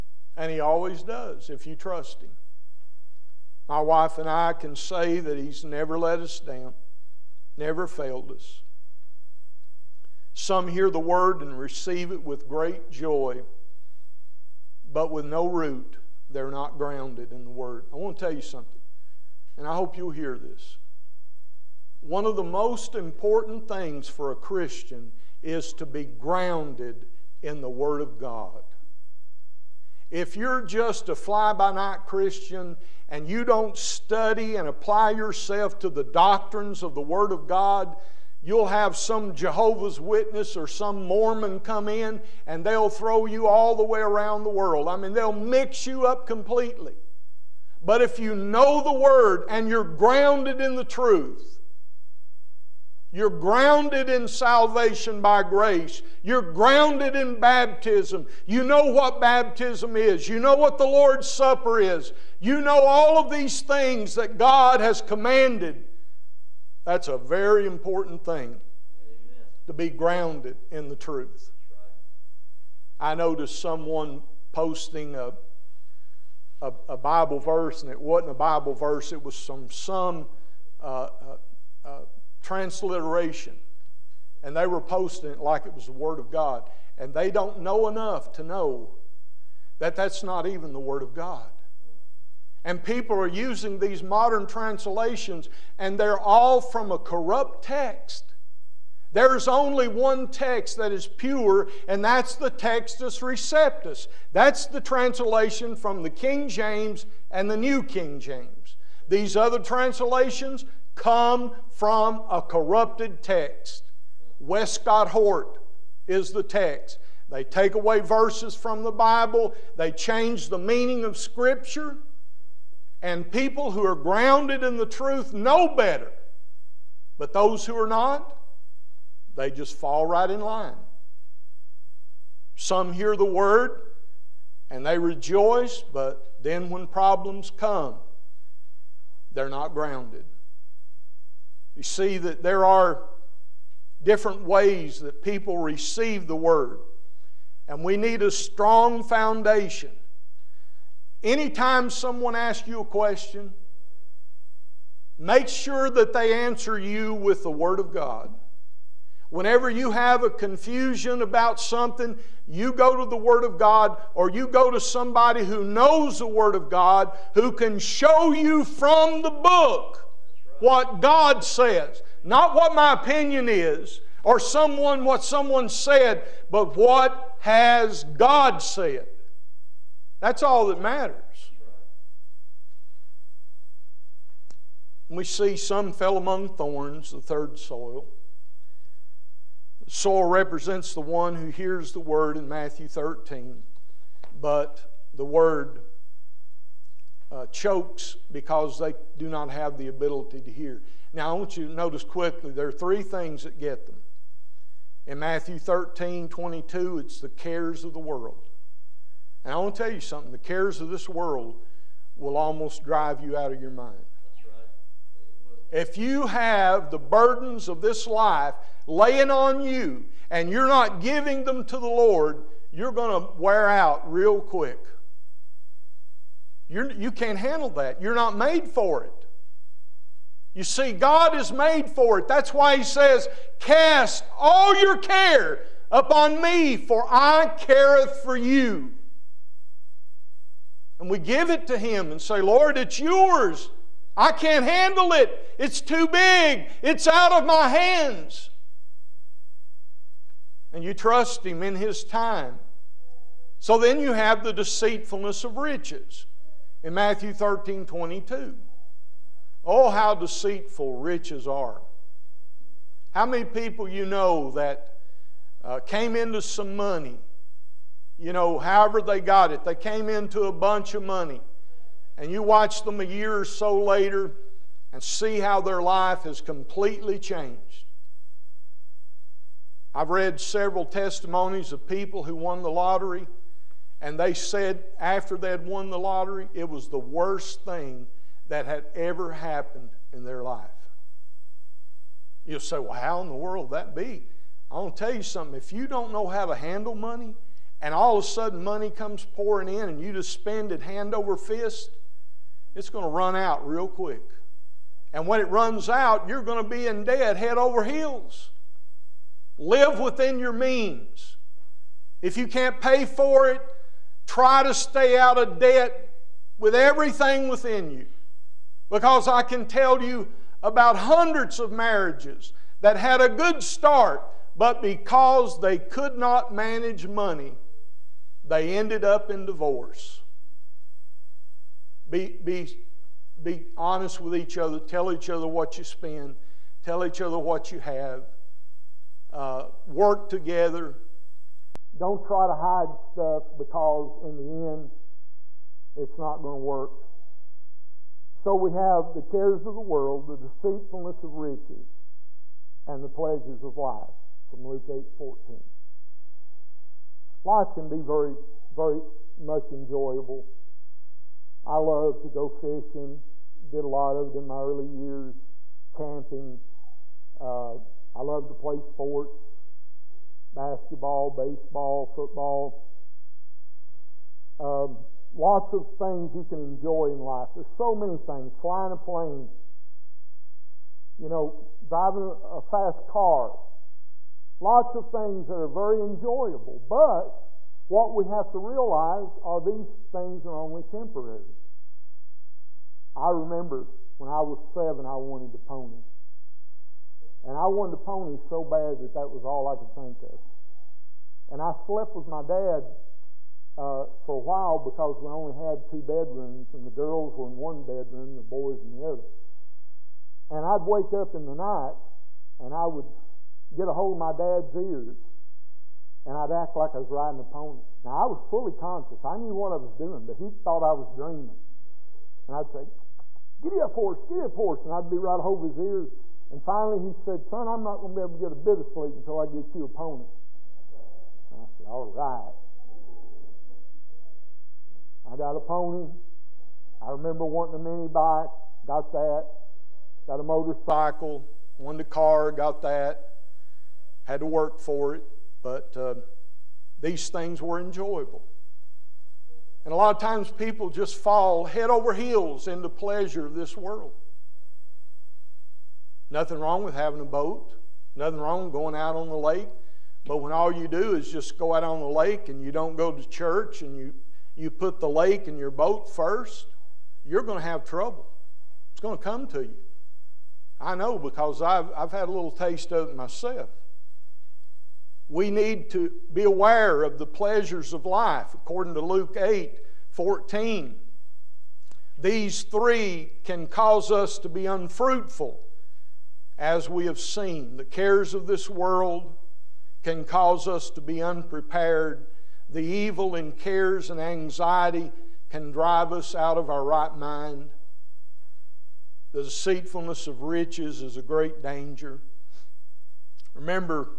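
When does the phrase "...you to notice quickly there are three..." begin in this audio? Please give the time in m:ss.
3:21.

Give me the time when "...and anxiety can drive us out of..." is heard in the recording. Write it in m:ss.
8:14.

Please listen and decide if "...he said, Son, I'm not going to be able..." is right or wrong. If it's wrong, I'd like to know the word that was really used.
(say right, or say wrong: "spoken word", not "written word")
right.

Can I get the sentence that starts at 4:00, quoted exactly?
And we give it to Him and say, Lord, it's yours.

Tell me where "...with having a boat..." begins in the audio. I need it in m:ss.
7:36.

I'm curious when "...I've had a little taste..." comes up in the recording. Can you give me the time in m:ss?
7:51.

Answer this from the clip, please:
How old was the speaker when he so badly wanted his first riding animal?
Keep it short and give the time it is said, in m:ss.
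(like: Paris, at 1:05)
7, at 6:34.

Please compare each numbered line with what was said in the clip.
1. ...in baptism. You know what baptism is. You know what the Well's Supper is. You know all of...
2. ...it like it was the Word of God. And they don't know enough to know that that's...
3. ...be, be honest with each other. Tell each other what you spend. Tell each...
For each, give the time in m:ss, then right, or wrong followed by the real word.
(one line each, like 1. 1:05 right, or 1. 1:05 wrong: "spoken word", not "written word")
1. 0:57 wrong: "Lord", not "Well"
2. 1:25 right
3. 5:32 right.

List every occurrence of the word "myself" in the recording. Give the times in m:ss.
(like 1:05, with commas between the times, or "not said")
7:53.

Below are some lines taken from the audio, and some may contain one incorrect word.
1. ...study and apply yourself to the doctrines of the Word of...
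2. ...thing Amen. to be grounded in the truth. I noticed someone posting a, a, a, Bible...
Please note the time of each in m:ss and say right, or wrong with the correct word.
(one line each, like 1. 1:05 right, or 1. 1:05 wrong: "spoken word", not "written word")
1. 0:33 right
2. 1:08 right.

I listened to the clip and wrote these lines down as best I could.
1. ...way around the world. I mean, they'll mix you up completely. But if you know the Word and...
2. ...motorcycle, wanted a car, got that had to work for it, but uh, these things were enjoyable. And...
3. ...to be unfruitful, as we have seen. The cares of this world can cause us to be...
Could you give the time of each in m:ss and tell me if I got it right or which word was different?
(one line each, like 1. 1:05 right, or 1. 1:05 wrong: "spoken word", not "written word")
1. 0:43 right
2. 7:20 right
3. 8:04 right.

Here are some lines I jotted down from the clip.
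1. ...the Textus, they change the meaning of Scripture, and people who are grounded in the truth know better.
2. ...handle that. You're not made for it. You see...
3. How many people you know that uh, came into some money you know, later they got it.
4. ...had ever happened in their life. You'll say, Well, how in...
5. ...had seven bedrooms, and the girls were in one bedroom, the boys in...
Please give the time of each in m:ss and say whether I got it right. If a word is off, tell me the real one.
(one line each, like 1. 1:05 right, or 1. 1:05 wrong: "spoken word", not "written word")
1. 1:58 wrong: "Bible", not "Textus"
2. 3:47 right
3. 4:23 wrong: "however", not "later"
4. 4:48 right
5. 6:45 wrong: "two", not "seven".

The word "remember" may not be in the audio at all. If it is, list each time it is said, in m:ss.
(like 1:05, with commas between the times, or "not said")
6:33, 7:17, 8:23.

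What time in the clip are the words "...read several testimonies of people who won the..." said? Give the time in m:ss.
4:40.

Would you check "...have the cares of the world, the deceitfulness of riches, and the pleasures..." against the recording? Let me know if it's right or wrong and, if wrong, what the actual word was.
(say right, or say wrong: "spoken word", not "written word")
right.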